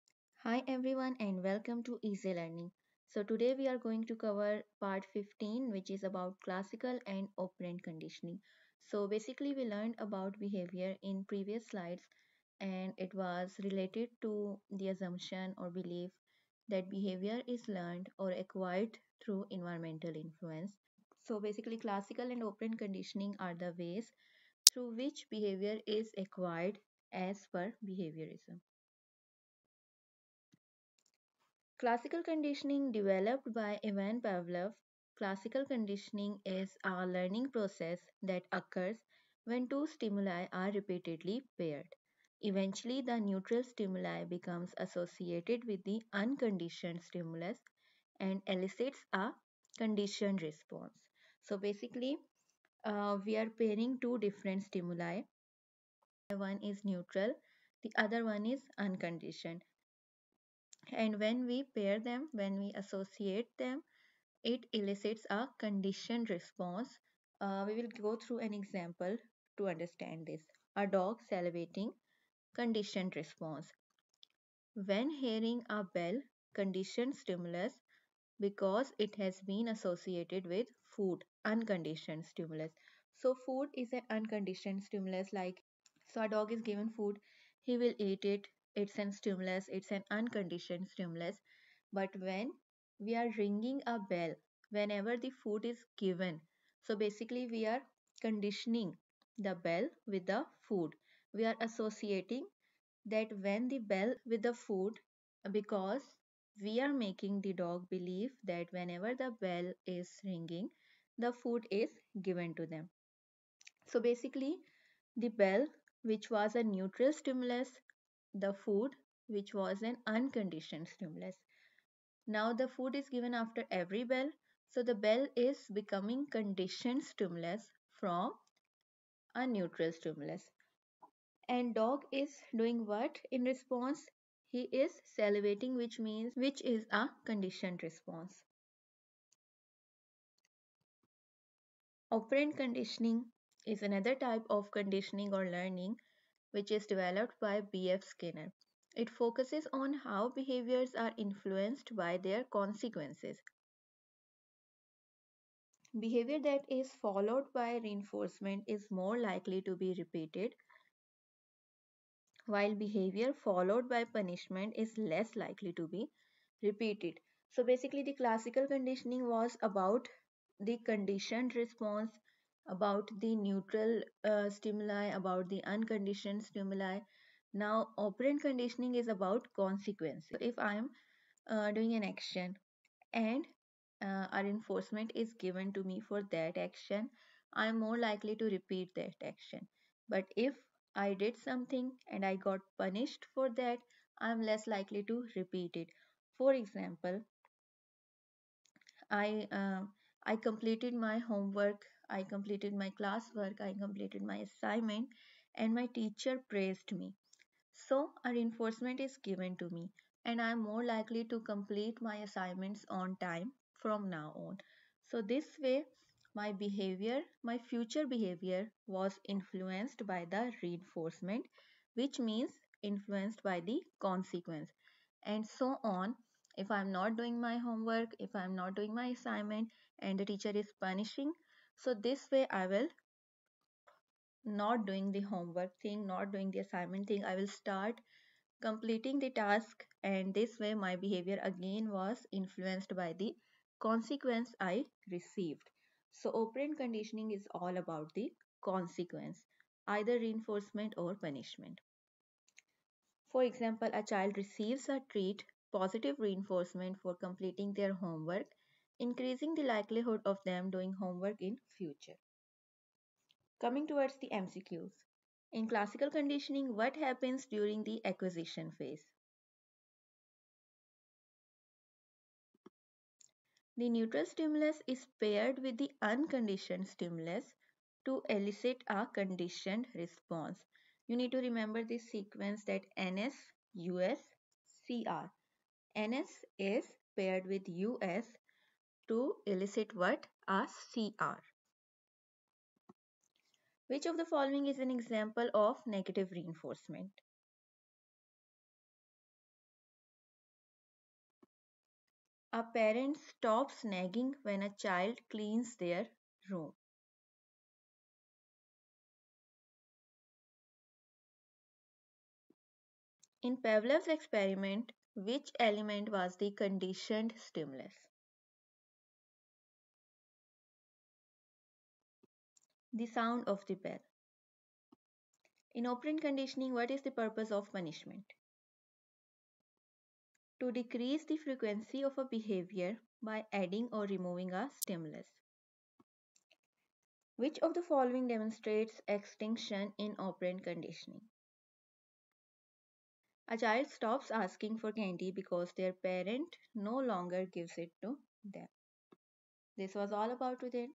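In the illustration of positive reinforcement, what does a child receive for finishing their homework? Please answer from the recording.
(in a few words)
A treat.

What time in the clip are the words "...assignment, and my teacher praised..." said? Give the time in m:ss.
3:24.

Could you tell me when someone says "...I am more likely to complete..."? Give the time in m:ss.
3:30.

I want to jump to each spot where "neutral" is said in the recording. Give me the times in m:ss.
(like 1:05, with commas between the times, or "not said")
0:43, 0:56, 1:56, 2:09, 2:53, 4:33.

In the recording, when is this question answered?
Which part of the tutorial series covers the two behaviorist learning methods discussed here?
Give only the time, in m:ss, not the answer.
0:04.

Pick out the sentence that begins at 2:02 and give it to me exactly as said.
Now the food is given after every bell.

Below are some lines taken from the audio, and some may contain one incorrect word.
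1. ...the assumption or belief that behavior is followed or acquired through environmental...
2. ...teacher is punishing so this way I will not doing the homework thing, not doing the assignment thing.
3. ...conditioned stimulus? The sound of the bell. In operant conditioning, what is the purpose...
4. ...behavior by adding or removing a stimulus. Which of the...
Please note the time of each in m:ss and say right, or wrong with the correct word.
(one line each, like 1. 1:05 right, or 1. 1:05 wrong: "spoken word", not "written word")
1. 0:14 wrong: "learned", not "followed"
2. 3:50 right
3. 5:16 right
4. 5:32 right.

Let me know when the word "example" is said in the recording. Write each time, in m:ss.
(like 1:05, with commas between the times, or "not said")
1:08, 3:16, 4:13, 4:54.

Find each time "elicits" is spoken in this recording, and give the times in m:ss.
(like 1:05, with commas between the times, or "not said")
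0:48, 1:04, 4:38, 4:49.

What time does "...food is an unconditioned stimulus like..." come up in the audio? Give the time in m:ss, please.
1:23.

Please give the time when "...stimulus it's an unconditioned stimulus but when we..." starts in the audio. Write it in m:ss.
1:29.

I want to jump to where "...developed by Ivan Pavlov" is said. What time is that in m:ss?
0:32.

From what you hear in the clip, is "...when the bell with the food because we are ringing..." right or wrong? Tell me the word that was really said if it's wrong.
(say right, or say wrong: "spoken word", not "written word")
wrong: "making", not "ringing".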